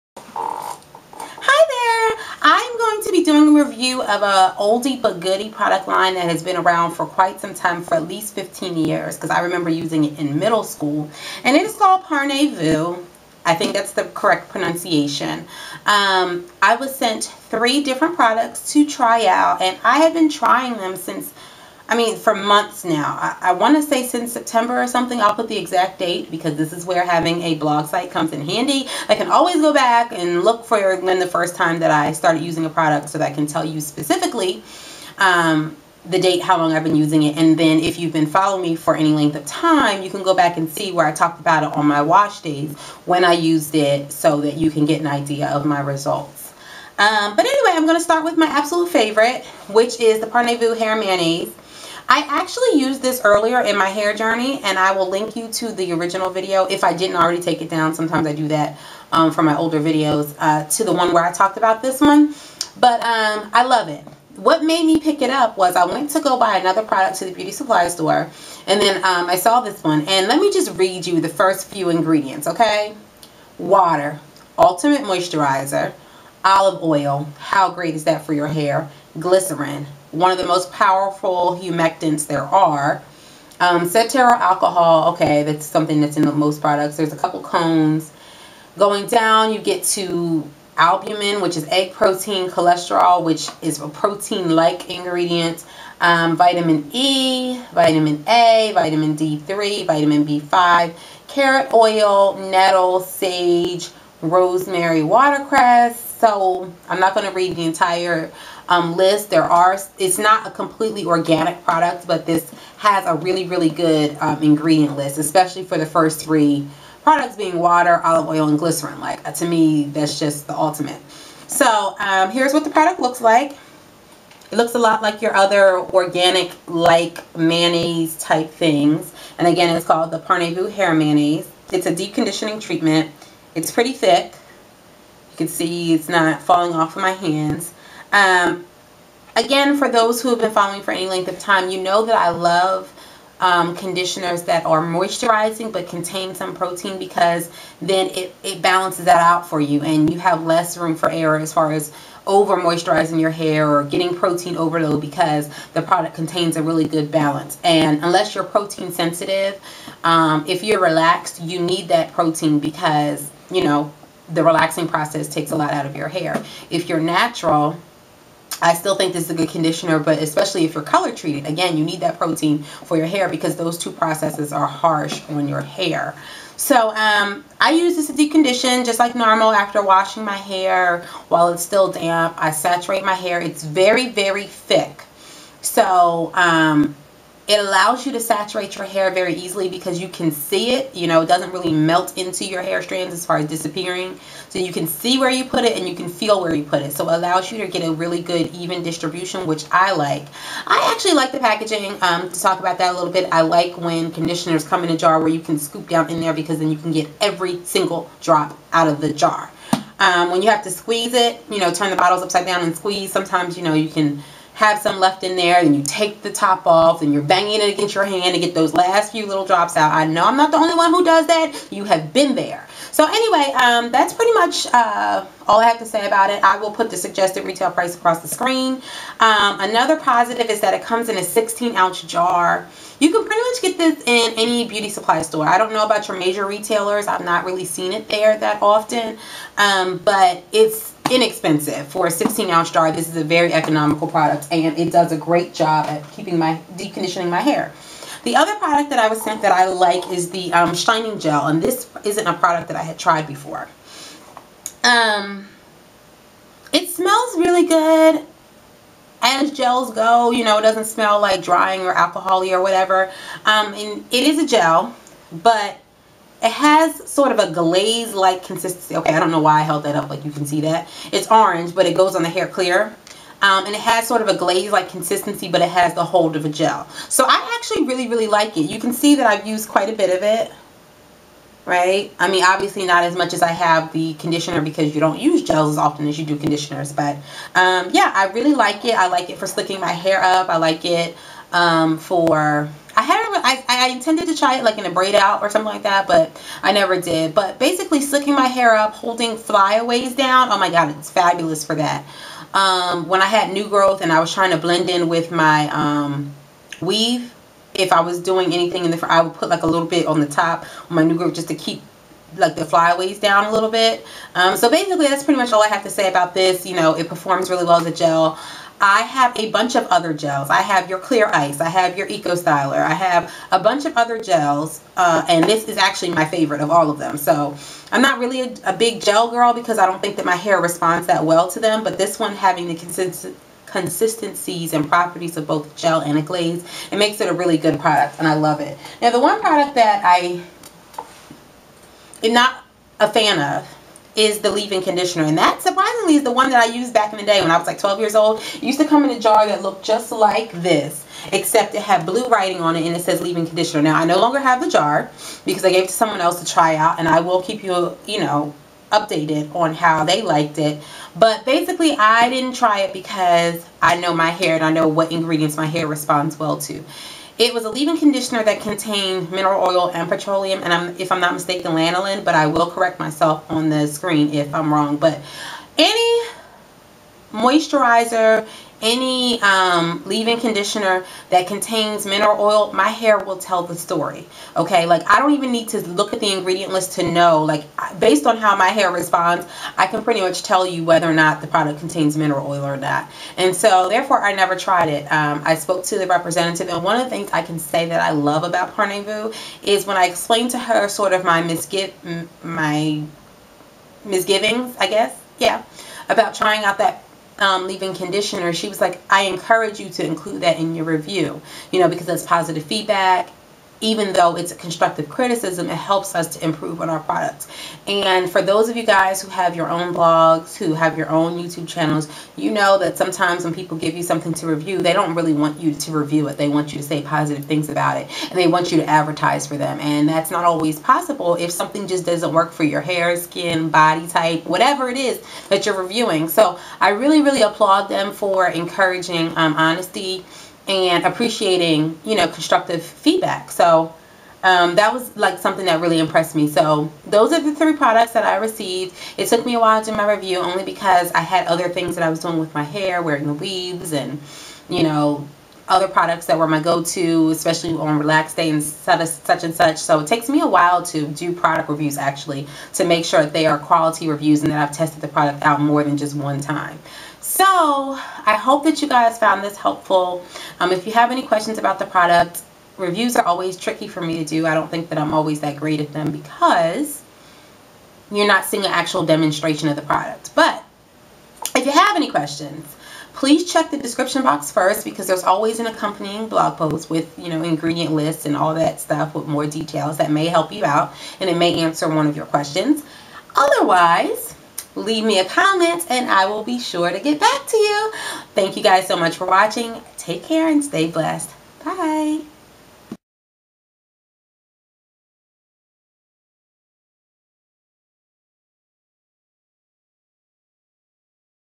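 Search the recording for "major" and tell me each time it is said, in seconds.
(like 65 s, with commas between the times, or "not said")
236 s.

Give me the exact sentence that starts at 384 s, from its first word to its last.
Okay, like I don't even need to look at the ingredient list to know.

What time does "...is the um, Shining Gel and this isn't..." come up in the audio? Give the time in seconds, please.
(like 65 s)
250 s.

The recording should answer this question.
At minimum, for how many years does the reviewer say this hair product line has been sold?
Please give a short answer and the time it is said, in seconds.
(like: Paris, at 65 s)
15 years, at 8 s.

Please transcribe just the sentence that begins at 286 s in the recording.
But um, yeah, I really like it.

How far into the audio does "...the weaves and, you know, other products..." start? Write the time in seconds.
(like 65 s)
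453 s.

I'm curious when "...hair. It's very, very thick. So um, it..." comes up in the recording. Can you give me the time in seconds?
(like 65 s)
183 s.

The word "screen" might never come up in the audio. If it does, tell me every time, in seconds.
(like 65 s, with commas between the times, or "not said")
228 s, 373 s.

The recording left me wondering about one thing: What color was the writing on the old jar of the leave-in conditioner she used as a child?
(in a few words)
Blue.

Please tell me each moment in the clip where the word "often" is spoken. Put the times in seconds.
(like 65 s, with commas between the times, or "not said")
238 s, 285 s.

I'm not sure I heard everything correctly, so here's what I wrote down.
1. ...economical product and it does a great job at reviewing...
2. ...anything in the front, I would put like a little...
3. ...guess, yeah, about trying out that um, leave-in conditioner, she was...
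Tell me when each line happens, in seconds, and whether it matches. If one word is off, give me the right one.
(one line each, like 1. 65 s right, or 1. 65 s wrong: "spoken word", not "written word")
1. 243 s wrong: "keeping", not "reviewing"
2. 308 s right
3. 404 s right.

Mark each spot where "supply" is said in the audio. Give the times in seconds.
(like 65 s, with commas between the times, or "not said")
67 s, 234 s.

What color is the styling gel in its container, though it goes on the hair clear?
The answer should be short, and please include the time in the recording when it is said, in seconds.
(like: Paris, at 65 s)
Orange, at 271 s.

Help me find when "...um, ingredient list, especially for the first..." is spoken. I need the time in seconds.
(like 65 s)
114 s.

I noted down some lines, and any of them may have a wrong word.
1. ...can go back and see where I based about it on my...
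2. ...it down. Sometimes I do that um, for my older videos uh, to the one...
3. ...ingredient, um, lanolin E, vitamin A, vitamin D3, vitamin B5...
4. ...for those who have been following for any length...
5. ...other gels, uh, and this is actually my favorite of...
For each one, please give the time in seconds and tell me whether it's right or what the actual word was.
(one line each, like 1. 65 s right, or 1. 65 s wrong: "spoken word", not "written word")
1. 40 s wrong: "talked", not "based"
2. 57 s right
3. 94 s wrong: "vitamin", not "lanolin"
4. 139 s right
5. 323 s right.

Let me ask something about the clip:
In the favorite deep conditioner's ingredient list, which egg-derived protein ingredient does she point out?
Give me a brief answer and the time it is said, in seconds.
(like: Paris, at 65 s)
Albumin, at 90 s.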